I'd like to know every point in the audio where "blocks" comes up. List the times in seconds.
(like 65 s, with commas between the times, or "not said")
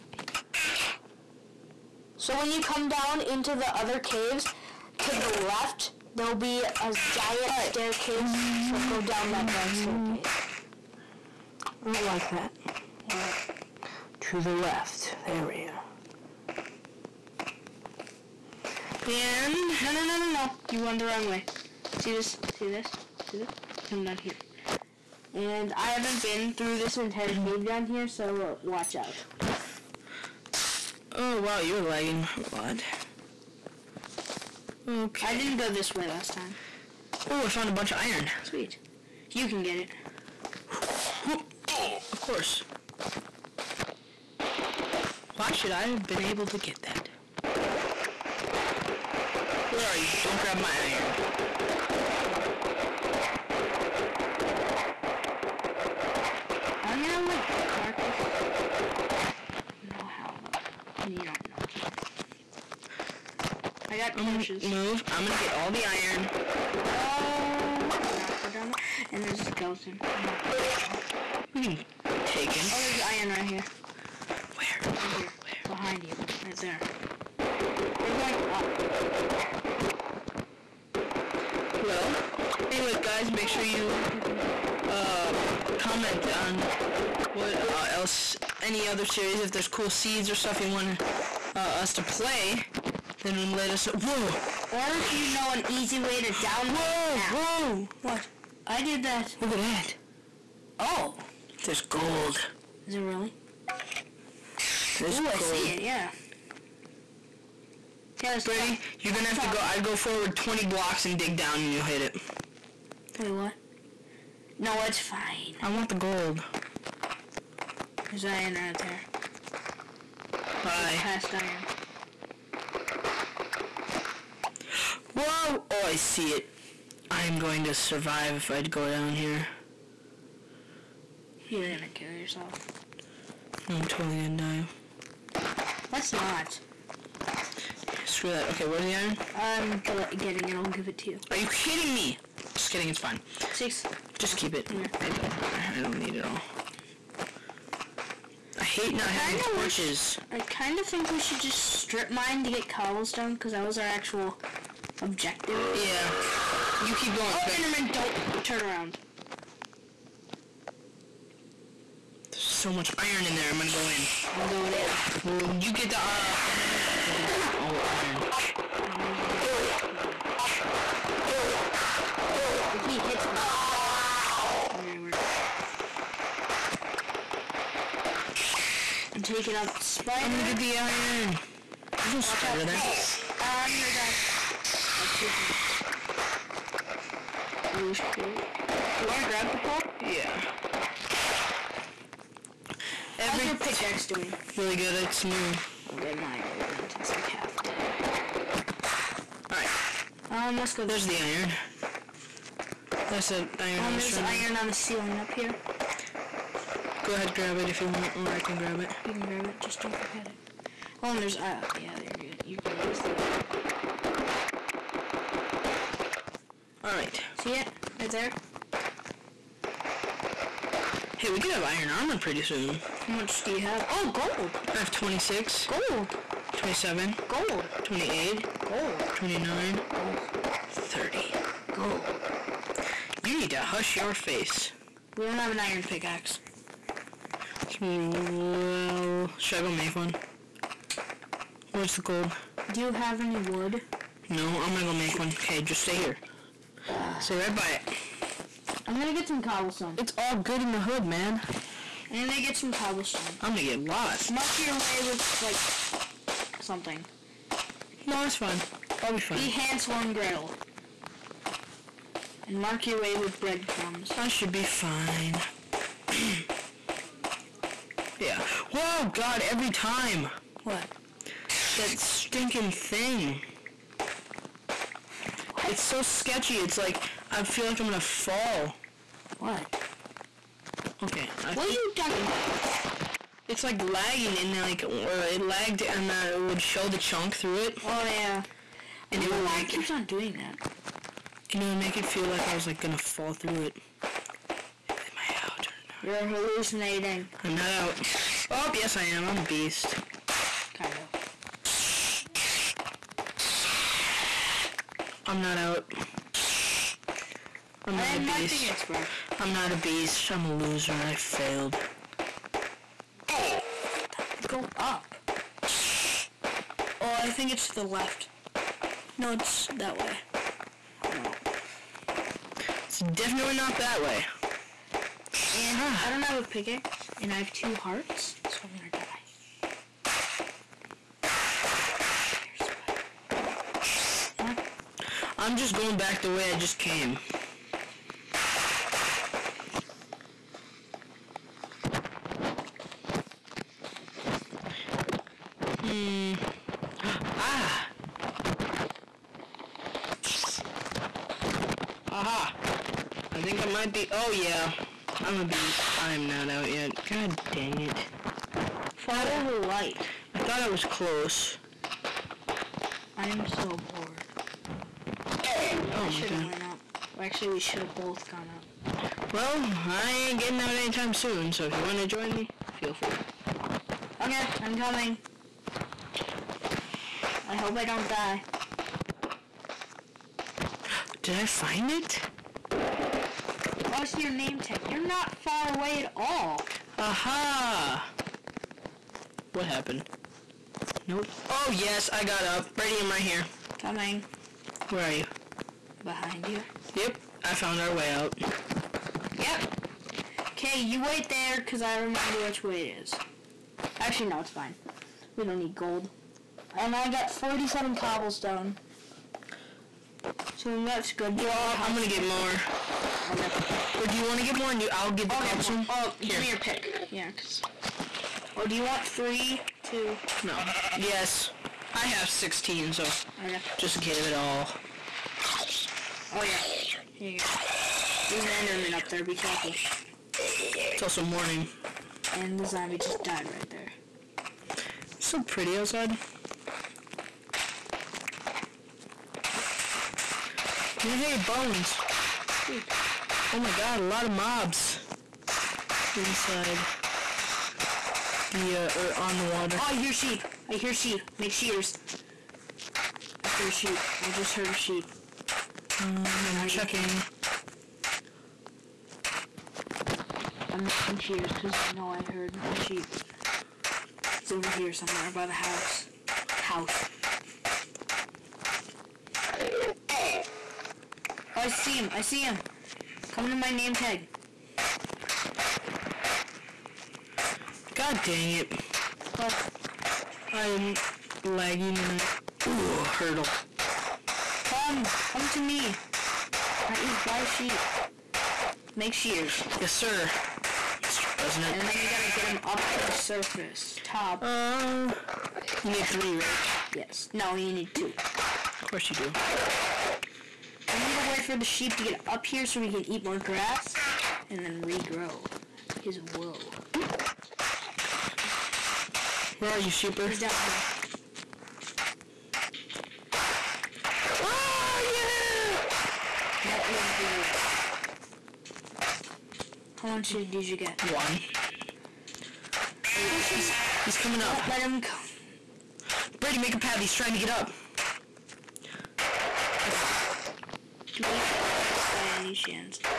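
110 s.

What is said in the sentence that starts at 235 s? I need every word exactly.
We don't have an iron pickaxe.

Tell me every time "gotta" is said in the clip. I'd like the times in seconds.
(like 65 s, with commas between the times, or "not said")
492 s.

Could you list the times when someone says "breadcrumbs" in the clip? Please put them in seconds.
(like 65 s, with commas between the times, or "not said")
263 s.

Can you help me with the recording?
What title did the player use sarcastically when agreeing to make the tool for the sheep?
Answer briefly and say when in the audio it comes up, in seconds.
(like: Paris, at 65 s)
Mr. President, at 491 s.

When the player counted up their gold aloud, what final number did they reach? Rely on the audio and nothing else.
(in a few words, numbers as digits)
30.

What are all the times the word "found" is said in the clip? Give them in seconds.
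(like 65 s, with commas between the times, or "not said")
37 s, 397 s.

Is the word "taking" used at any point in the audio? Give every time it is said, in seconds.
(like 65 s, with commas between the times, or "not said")
179 s, 185 s.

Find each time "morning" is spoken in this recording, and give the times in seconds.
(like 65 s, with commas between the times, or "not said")
431 s.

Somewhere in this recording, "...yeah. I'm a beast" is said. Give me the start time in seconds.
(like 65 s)
354 s.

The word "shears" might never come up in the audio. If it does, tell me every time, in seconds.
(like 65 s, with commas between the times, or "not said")
451 s, 489 s.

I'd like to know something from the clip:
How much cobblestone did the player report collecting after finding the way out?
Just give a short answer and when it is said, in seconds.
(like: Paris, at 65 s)
47, at 407 s.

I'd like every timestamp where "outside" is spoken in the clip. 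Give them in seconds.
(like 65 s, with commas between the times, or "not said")
435 s.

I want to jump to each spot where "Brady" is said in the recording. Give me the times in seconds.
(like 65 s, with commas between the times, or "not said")
108 s, 392 s, 526 s.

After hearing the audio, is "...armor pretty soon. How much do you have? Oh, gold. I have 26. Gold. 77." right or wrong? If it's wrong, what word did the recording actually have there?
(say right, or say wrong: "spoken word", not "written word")
wrong: "27", not "77".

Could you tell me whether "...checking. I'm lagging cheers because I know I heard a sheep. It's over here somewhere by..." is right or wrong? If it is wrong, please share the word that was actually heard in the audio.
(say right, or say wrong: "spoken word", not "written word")
wrong: "making", not "lagging".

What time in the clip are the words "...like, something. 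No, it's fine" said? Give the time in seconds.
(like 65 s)
255 s.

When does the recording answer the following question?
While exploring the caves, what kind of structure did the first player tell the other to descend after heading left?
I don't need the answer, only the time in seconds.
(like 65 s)
9 s.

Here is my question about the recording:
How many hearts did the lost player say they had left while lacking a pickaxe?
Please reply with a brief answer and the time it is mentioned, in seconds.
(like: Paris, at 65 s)
2, at 327 s.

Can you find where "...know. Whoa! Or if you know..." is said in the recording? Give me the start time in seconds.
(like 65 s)
93 s.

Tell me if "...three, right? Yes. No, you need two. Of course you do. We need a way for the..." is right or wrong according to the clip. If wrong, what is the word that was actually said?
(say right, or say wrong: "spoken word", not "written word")
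right.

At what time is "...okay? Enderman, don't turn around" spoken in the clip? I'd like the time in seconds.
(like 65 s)
157 s.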